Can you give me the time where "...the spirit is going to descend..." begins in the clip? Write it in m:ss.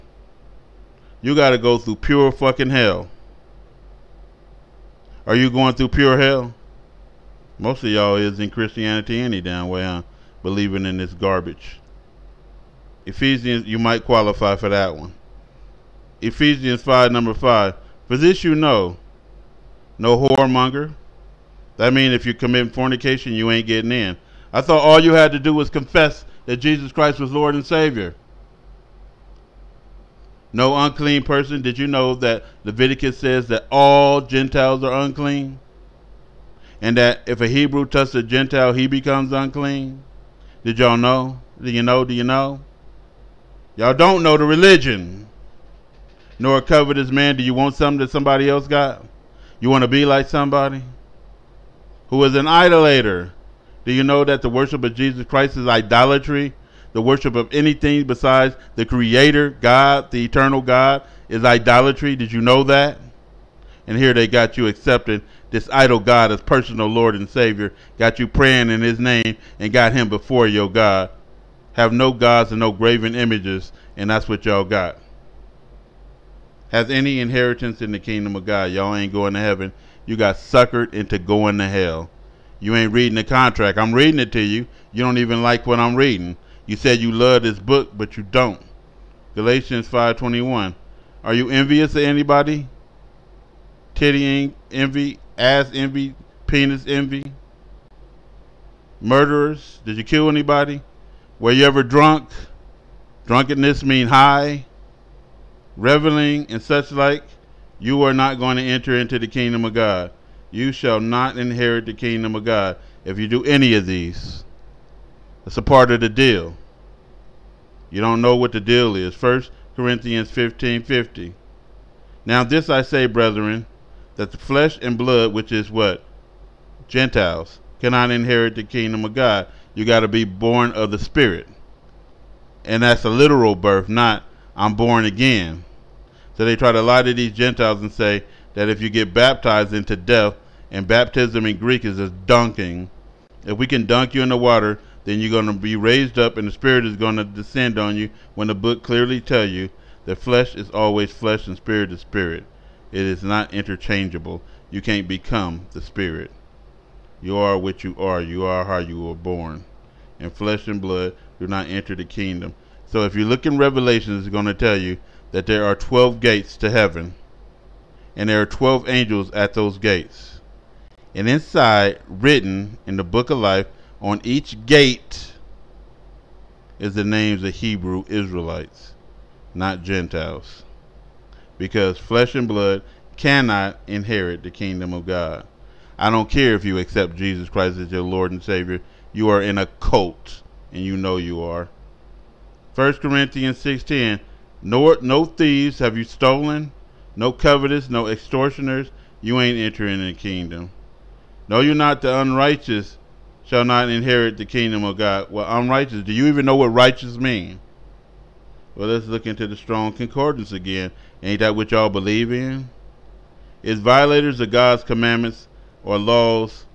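2:26.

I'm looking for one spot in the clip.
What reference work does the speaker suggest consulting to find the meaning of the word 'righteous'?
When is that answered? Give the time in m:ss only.
3:29.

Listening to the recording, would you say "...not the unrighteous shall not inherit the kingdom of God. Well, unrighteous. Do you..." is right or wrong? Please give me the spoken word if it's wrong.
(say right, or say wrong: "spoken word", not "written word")
right.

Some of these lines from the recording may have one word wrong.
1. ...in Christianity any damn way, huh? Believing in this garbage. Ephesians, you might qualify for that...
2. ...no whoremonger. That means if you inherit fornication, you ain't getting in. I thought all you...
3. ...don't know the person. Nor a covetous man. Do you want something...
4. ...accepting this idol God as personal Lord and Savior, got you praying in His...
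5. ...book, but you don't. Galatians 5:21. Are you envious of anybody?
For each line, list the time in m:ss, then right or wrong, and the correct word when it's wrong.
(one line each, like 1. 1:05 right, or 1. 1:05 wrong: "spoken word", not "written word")
1. 0:08 right
2. 0:19 wrong: "commit", not "inherit"
3. 0:43 wrong: "religion", not "person"
4. 1:04 right
5. 1:27 right.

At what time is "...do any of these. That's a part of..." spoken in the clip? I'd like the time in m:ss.
1:53.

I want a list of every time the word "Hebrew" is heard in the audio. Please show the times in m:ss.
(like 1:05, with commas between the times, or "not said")
0:37, 2:57.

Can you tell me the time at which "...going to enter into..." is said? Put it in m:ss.
1:48.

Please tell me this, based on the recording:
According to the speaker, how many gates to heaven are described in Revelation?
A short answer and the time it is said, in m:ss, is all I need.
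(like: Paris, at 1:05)
12, at 2:45.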